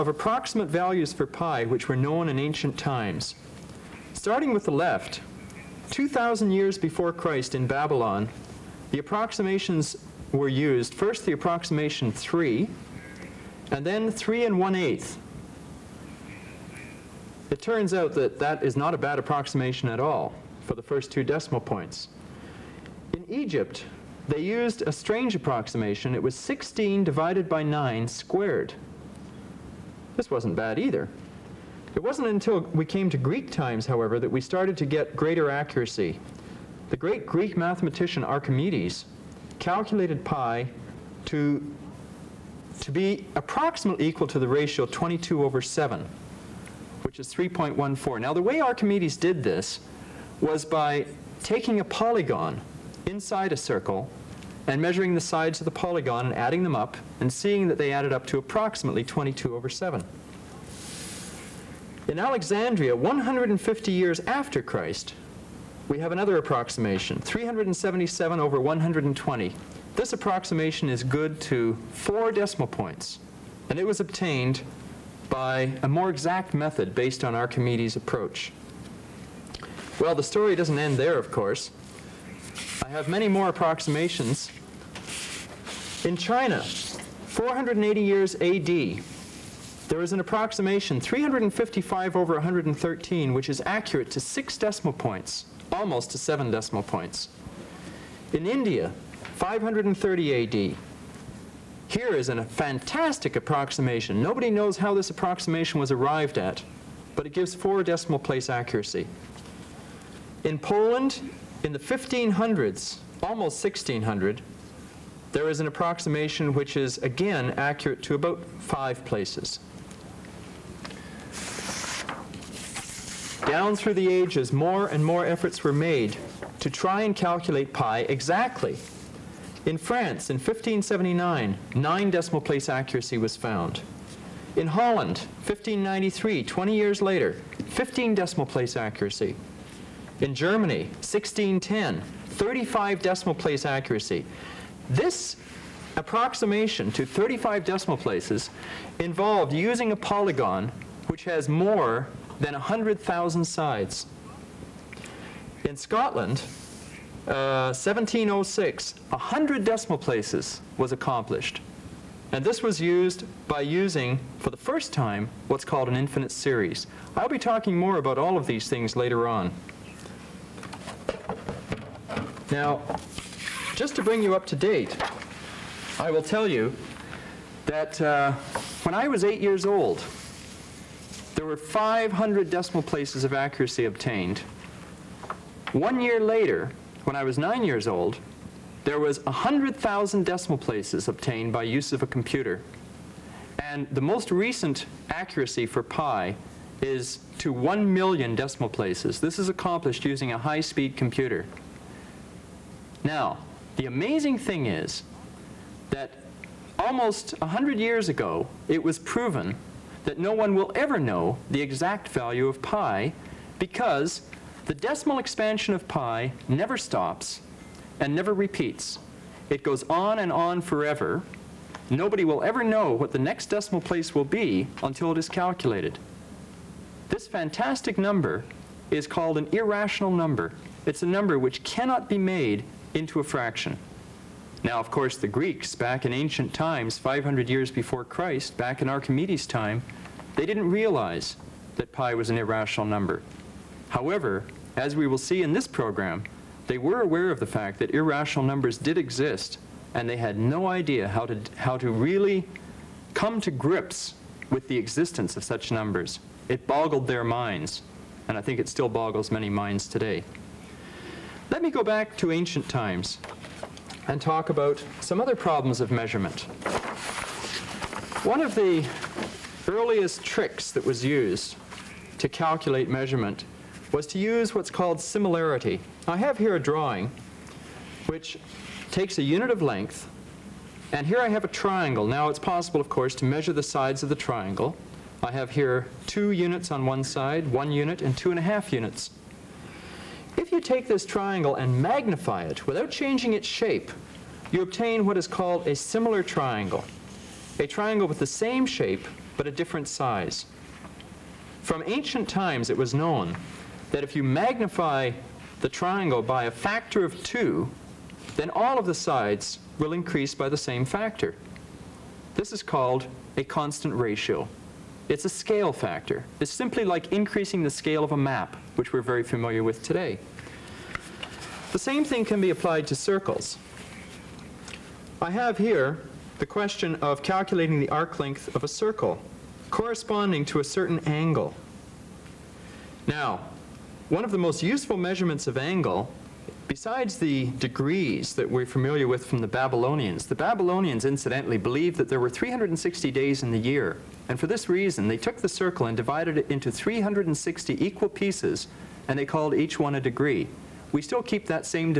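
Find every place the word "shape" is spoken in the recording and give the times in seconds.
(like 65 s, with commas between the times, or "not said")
293 s, 298 s.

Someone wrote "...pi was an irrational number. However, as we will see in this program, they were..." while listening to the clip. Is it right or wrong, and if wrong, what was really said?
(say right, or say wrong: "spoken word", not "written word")
right.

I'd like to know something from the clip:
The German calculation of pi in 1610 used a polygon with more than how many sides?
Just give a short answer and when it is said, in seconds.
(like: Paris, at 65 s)
100,000, at 152 s.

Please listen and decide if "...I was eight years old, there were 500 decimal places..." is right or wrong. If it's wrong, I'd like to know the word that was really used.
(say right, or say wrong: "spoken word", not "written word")
right.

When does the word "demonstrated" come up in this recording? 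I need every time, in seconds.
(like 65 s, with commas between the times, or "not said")
not said.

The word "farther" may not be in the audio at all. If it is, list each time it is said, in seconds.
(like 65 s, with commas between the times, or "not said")
not said.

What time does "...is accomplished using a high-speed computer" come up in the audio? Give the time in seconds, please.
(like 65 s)
199 s.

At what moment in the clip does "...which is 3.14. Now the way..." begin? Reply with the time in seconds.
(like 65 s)
47 s.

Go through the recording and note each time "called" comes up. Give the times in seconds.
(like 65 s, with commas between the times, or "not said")
165 s, 229 s, 274 s, 295 s, 312 s, 349 s.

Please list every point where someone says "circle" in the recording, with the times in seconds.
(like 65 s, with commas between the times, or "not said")
53 s, 322 s, 328 s, 345 s.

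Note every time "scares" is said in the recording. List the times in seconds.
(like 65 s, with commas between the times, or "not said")
not said.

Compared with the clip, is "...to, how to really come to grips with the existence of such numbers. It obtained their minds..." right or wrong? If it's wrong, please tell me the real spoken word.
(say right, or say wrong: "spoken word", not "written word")
wrong: "boggled", not "obtained".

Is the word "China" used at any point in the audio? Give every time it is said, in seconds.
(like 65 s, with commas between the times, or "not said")
86 s.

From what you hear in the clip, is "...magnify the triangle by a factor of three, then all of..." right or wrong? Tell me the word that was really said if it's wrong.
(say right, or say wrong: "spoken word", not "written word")
wrong: "two", not "three".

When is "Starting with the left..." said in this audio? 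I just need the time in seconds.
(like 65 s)
4 s.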